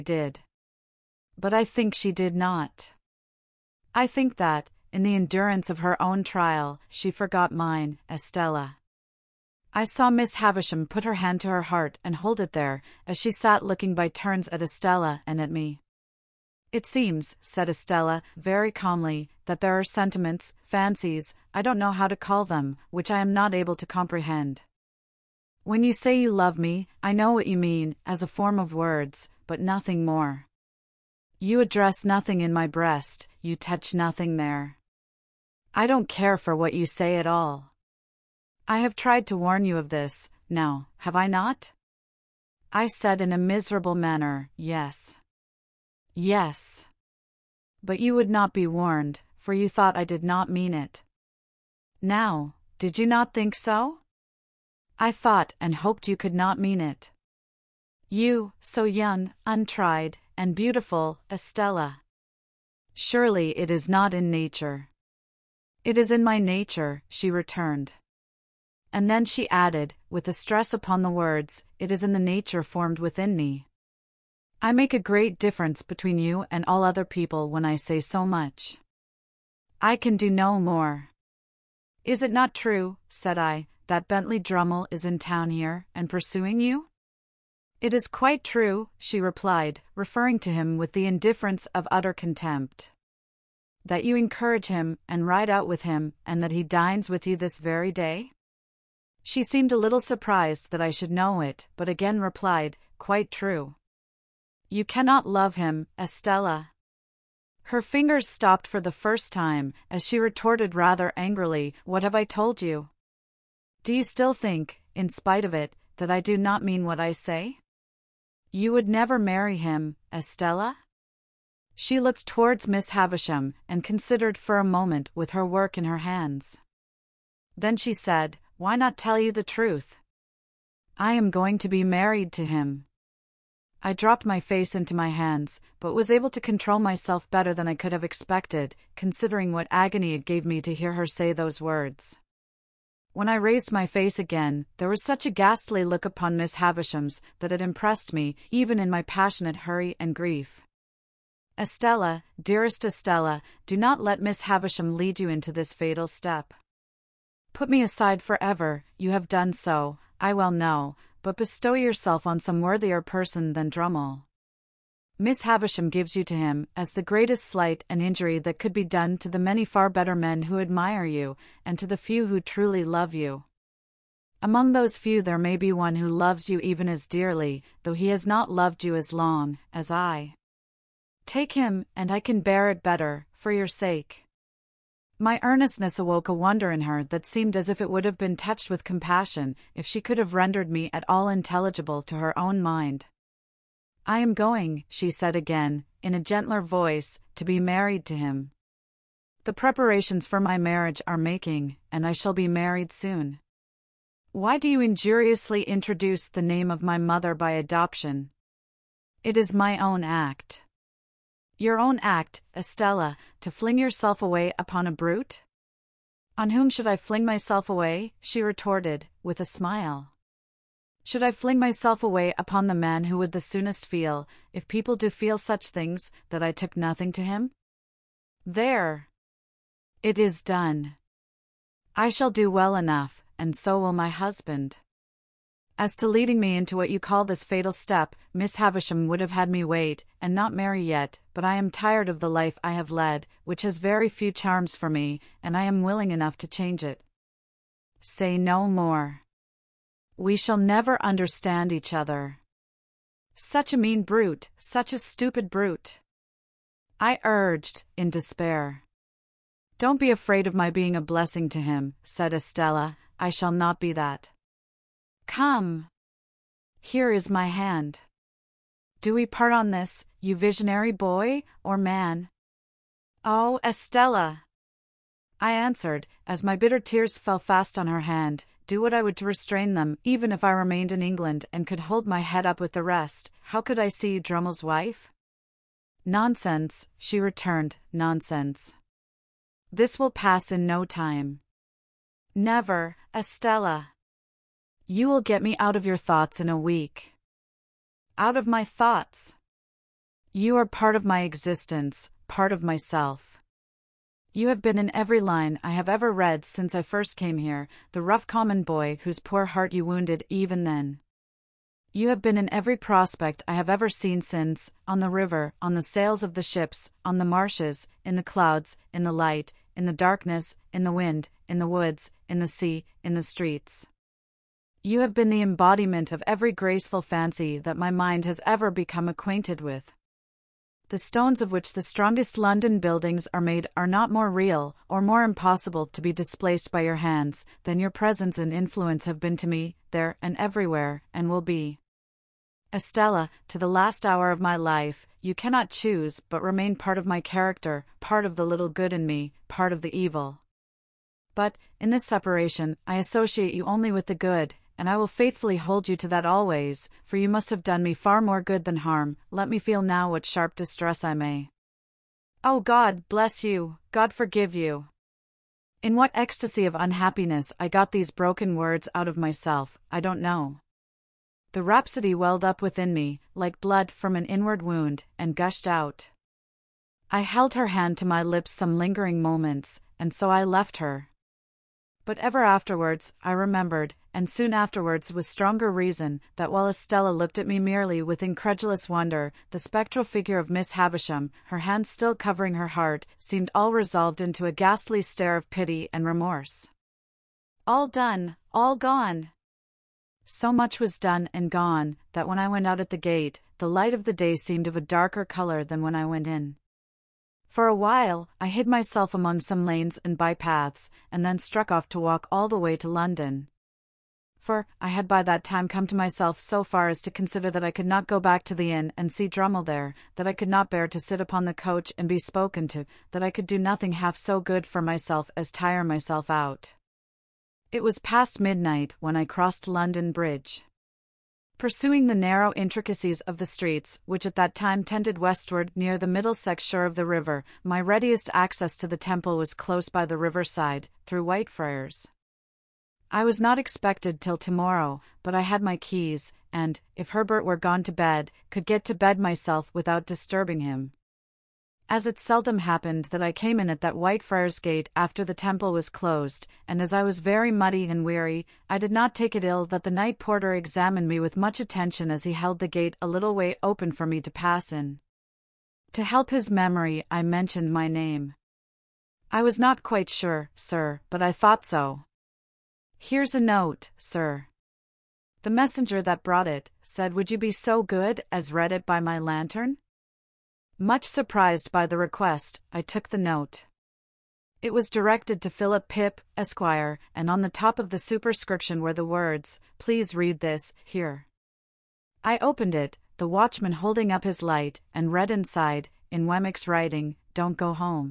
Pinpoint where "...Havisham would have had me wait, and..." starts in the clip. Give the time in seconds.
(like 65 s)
238 s.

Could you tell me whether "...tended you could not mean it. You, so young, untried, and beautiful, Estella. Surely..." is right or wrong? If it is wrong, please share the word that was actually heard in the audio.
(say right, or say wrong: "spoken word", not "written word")
wrong: "hoped", not "tended".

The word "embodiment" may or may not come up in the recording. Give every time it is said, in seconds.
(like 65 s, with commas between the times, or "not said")
325 s.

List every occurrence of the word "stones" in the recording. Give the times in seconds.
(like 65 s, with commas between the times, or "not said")
330 s.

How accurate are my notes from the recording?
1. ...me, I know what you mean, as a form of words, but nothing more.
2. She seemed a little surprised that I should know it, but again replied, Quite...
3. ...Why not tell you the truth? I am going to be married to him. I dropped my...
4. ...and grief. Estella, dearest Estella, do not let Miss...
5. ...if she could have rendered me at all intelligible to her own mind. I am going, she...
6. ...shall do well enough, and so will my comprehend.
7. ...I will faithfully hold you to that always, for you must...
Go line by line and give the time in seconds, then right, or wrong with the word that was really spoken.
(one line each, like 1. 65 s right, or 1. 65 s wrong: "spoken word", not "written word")
1. 26 s right
2. 99 s right
3. 128 s right
4. 150 s right
5. 189 s right
6. 232 s wrong: "husband", not "comprehend"
7. 354 s right.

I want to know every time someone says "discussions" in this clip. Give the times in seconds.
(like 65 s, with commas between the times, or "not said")
not said.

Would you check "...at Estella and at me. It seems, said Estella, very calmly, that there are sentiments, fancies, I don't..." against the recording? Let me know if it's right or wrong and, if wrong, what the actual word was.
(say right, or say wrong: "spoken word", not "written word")
right.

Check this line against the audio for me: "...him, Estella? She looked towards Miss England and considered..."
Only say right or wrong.
wrong.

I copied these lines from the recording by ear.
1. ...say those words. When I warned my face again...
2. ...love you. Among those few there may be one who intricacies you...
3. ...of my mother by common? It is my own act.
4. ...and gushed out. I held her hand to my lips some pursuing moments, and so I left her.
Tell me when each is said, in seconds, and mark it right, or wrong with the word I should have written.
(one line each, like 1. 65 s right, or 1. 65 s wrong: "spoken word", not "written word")
1. 141 s wrong: "raised", not "warned"
2. 172 s wrong: "loves", not "intricacies"
3. 206 s wrong: "adoption", not "common"
4. 375 s wrong: "lingering", not "pursuing".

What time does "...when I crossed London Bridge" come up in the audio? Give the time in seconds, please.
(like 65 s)
429 s.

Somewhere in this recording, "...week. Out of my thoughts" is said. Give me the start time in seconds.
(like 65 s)
296 s.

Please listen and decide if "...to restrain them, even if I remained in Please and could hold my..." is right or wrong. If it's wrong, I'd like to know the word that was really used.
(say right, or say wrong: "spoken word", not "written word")
wrong: "England", not "Please".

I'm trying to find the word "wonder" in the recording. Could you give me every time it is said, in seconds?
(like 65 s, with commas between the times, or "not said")
186 s, 388 s.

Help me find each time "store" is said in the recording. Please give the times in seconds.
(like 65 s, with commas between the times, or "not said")
not said.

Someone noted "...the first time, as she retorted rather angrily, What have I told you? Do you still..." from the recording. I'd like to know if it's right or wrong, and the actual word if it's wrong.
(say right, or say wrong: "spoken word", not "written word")
right.